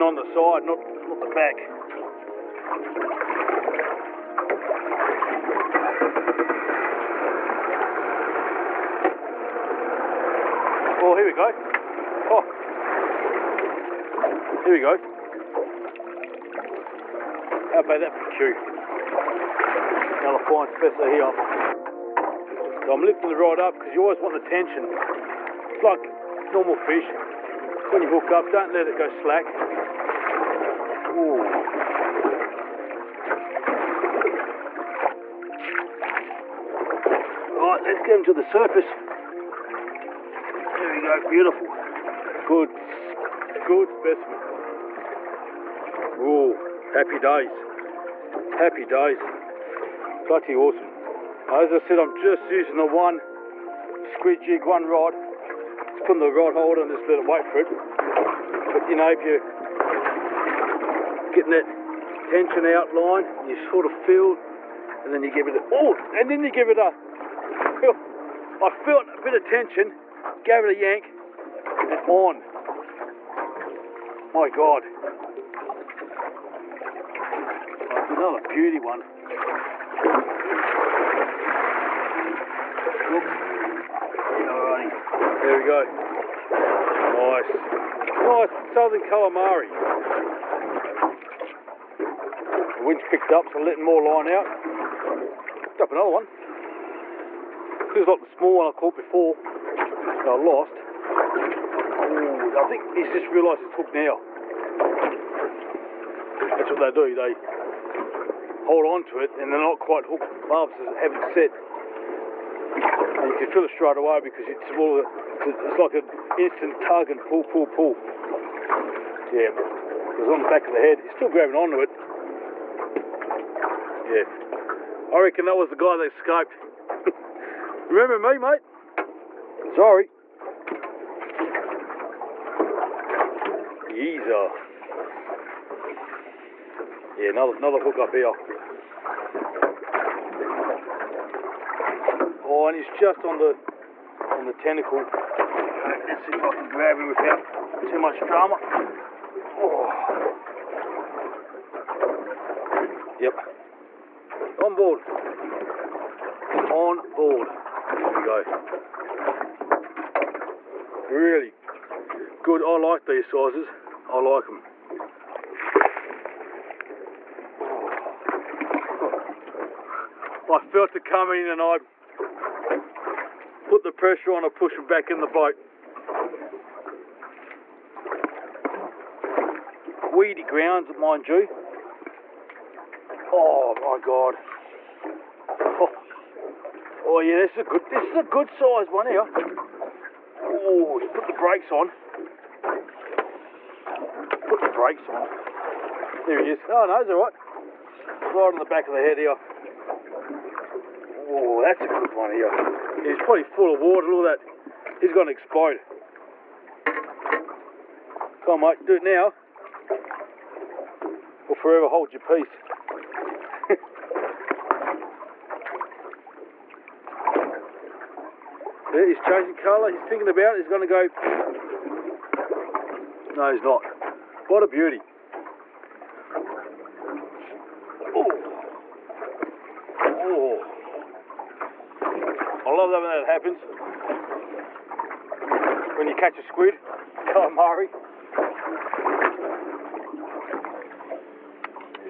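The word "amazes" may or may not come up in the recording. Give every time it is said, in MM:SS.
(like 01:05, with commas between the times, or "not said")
not said.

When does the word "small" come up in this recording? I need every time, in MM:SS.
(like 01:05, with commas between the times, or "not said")
01:38.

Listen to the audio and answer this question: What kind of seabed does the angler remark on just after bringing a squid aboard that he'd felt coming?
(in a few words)
Weedy grounds.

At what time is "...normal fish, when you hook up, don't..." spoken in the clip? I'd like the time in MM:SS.
00:26.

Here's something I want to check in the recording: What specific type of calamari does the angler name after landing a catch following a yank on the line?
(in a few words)
southern calamari.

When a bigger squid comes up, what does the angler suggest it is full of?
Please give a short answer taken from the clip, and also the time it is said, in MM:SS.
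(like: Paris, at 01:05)
water, at 03:23.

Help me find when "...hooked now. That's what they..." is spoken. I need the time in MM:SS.
01:43.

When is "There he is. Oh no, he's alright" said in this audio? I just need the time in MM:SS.
03:16.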